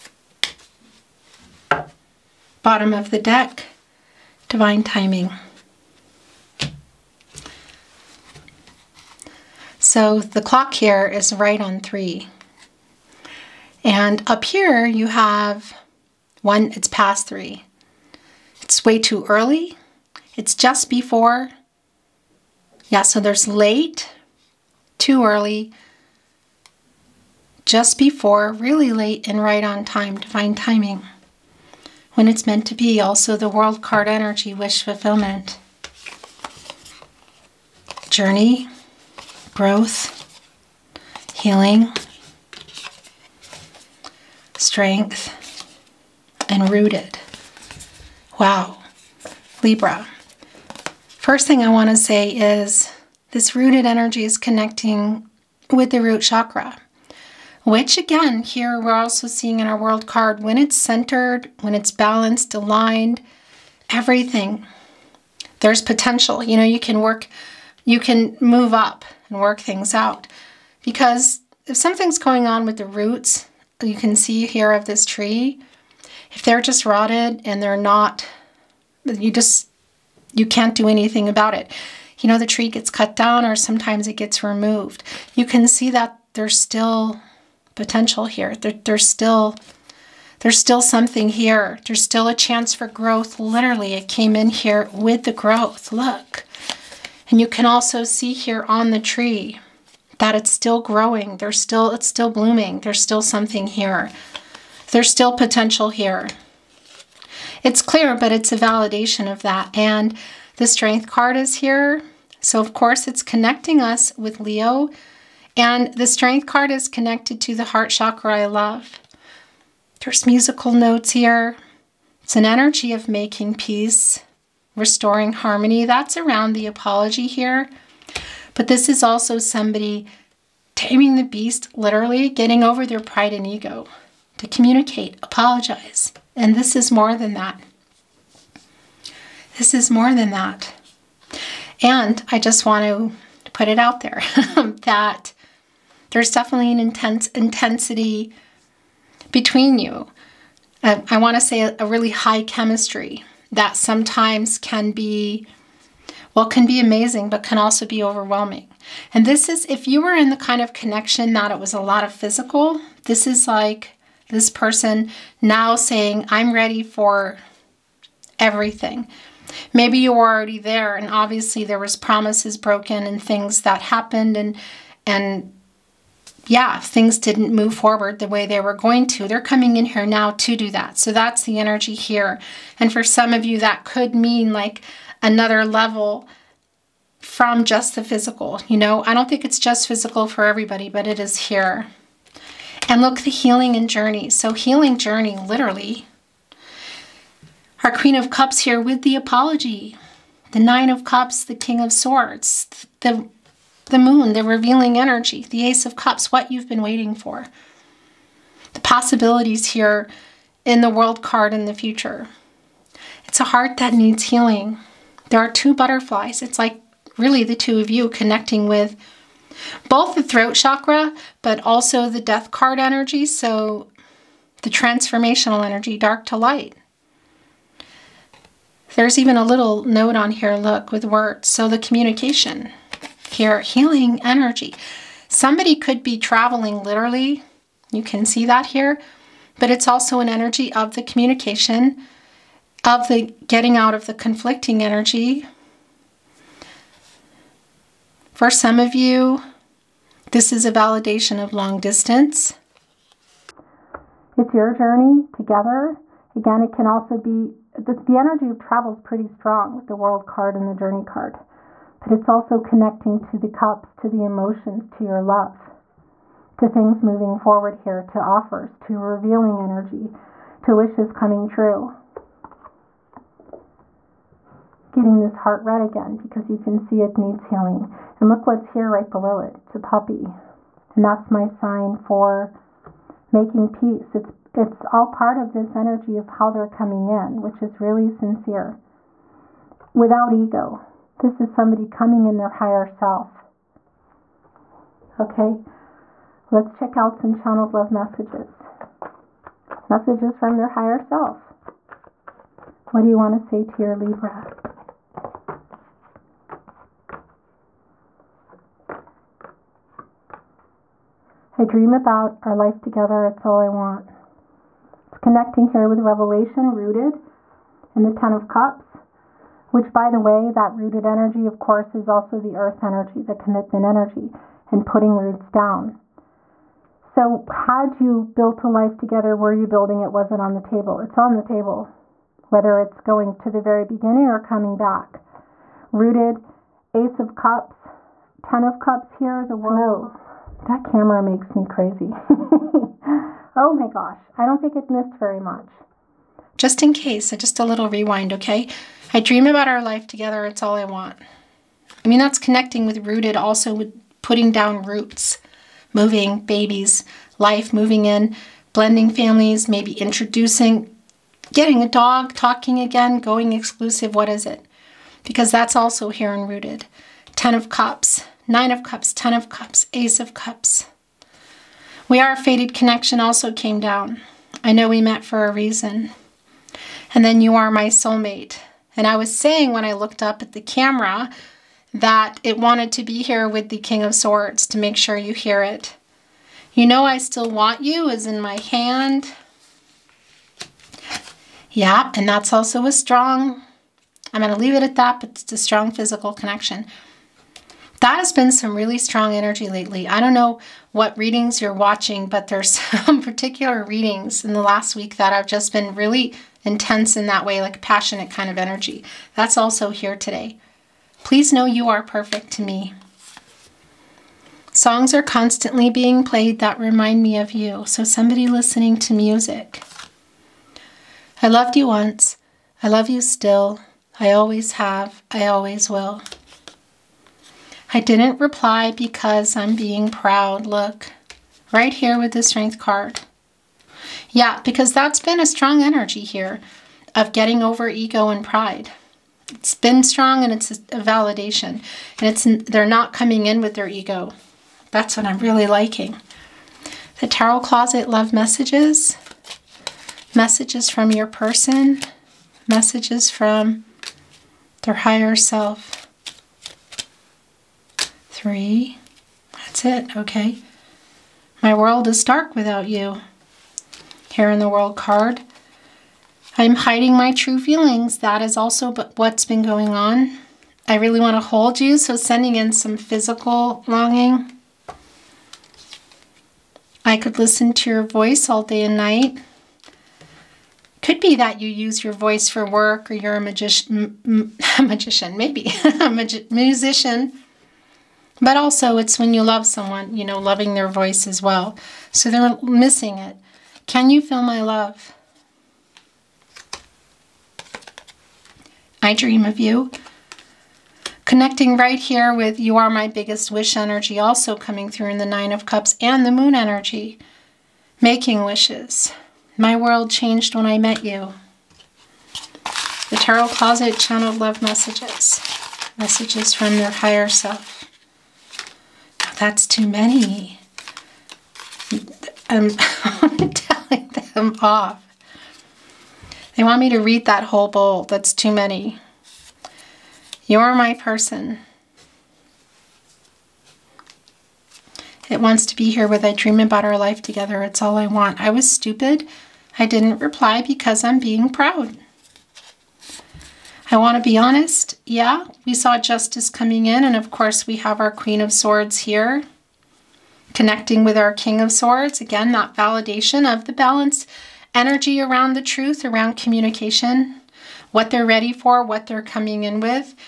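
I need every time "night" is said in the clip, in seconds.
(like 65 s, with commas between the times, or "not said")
478 s.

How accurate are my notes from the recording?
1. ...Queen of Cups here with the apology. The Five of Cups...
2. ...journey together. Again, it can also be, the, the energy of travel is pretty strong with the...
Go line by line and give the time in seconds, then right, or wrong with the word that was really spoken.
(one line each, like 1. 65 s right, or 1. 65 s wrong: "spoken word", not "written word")
1. 197 s wrong: "Nine", not "Five"
2. 254 s right.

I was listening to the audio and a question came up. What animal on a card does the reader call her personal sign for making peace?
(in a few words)
A puppy.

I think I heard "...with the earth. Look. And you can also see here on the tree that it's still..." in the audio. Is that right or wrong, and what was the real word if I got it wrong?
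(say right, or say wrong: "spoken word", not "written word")
wrong: "growth", not "earth".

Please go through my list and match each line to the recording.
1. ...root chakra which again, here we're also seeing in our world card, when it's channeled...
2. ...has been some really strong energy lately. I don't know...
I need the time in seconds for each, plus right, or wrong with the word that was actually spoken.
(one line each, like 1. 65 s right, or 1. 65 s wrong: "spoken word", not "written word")
1. 55 s wrong: "centered", not "channeled"
2. 398 s right.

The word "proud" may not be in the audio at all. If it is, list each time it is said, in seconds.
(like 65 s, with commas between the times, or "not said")
430 s, 541 s.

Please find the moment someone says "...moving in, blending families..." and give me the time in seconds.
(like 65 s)
357 s.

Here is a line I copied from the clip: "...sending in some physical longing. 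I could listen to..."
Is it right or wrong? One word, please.
right.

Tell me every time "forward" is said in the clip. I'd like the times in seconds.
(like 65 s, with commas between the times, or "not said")
177 s, 267 s.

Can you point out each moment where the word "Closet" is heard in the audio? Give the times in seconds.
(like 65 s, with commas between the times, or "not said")
447 s, 513 s.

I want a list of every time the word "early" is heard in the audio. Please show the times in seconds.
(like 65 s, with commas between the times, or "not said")
19 s, 25 s.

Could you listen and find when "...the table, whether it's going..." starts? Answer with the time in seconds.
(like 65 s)
331 s.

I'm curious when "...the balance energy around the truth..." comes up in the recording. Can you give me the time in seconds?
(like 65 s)
553 s.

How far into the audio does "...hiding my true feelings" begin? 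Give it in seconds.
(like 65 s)
466 s.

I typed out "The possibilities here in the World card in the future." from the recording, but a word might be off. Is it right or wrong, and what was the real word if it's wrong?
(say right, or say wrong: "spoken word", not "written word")
right.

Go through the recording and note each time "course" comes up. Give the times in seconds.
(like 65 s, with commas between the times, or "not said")
112 s, 321 s, 547 s.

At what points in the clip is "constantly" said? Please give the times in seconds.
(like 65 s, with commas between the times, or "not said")
415 s.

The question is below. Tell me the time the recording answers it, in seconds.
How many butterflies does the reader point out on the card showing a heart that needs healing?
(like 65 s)
215 s.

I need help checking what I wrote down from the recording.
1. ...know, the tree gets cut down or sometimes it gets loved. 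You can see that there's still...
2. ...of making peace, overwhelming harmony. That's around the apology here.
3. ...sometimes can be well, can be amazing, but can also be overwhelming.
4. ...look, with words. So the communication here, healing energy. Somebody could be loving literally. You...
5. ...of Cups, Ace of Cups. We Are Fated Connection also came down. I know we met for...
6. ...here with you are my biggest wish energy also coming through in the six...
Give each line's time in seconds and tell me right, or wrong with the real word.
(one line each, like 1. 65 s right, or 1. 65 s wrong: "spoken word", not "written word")
1. 82 s wrong: "removed", not "loved"
2. 122 s wrong: "restoring", not "overwhelming"
3. 153 s right
4. 230 s wrong: "traveling", not "loving"
5. 369 s right
6. 501 s wrong: "nine", not "six".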